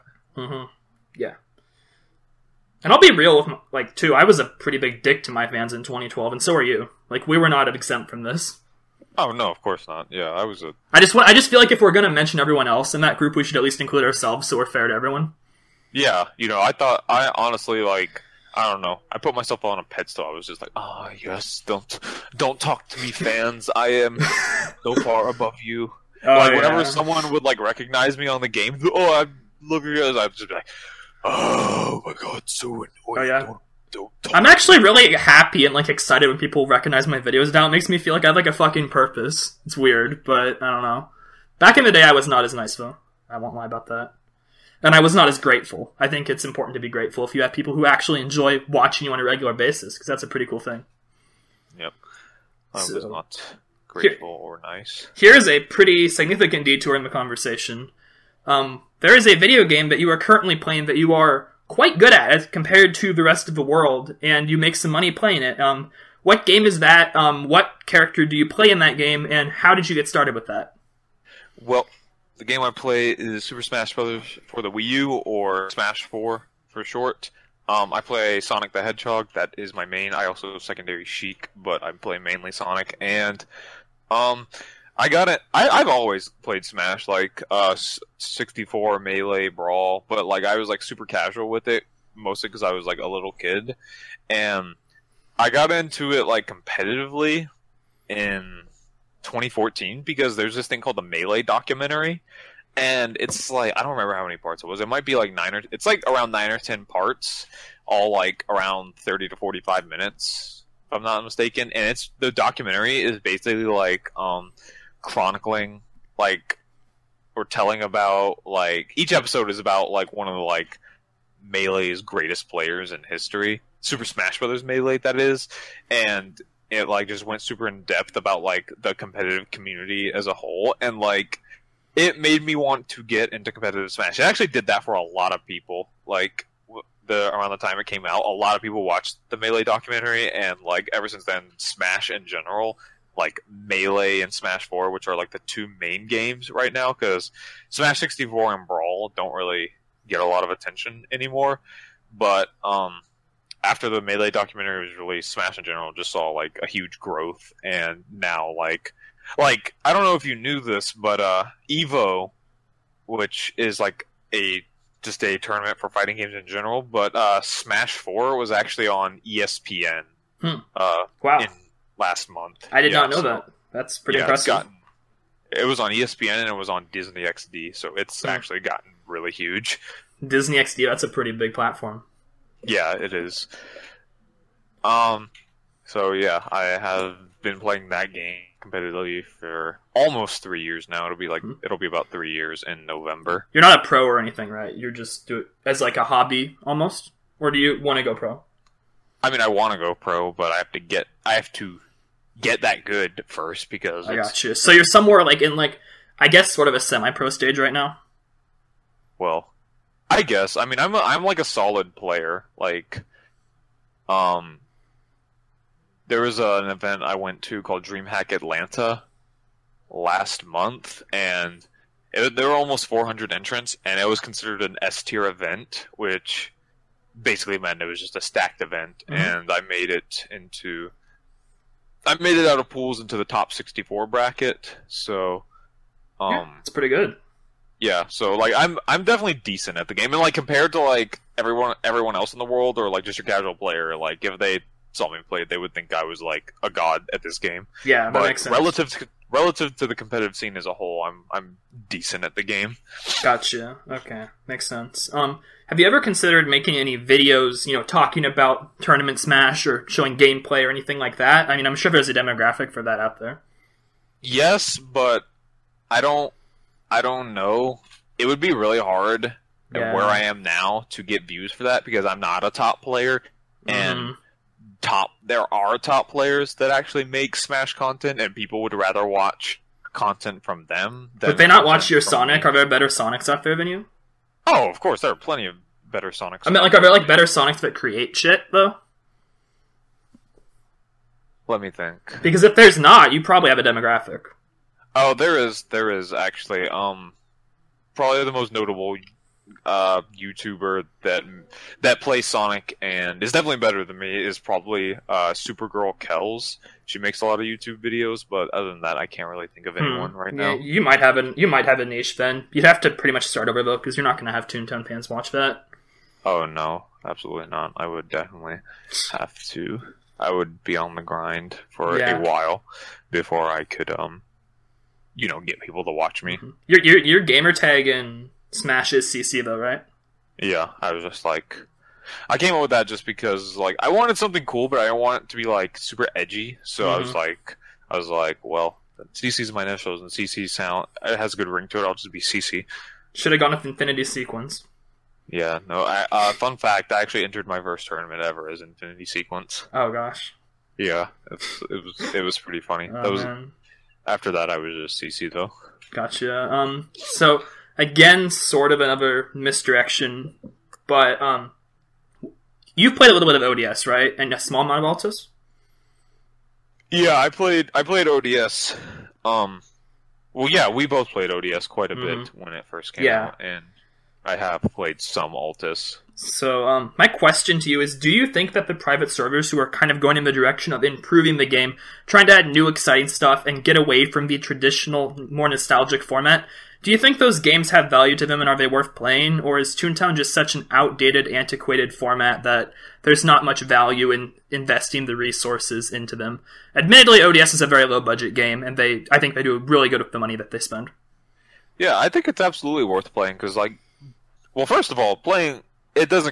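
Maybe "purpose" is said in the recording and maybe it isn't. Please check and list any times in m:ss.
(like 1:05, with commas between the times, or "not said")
0:38.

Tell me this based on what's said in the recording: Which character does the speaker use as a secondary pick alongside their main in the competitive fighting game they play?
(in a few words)
Sheik.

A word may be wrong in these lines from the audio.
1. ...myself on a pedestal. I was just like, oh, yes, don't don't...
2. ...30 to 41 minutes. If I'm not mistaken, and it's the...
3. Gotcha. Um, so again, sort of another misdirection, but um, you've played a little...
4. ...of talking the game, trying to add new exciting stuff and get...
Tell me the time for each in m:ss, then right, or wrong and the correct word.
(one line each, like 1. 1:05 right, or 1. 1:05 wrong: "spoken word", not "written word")
1. 0:19 right
2. 1:48 wrong: "45", not "41"
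3. 5:55 right
4. 6:20 wrong: "improving", not "talking".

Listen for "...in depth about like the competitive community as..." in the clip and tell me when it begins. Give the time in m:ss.
2:07.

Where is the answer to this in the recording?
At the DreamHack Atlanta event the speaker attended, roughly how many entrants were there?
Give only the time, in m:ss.
3:42.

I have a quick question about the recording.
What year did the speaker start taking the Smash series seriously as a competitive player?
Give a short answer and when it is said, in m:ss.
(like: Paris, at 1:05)
2014, at 1:39.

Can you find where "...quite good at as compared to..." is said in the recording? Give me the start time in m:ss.
1:01.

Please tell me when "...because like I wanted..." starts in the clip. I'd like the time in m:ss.
5:33.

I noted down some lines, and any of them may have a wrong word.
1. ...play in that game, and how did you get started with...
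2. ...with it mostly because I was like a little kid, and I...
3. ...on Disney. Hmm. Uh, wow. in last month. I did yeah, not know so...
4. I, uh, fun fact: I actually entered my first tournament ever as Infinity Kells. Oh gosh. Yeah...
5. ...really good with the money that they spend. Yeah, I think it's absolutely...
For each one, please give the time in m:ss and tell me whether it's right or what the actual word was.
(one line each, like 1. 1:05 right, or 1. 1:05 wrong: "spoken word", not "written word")
1. 1:08 right
2. 1:31 right
3. 2:48 wrong: "ESPN", not "Disney"
4. 5:45 wrong: "Sequence", not "Kells"
5. 6:39 right.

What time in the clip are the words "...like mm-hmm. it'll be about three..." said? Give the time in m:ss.
3:11.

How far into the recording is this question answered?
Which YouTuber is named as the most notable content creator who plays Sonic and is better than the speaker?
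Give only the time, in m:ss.
5:05.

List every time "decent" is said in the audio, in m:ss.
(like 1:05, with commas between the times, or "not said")
3:59, 4:11.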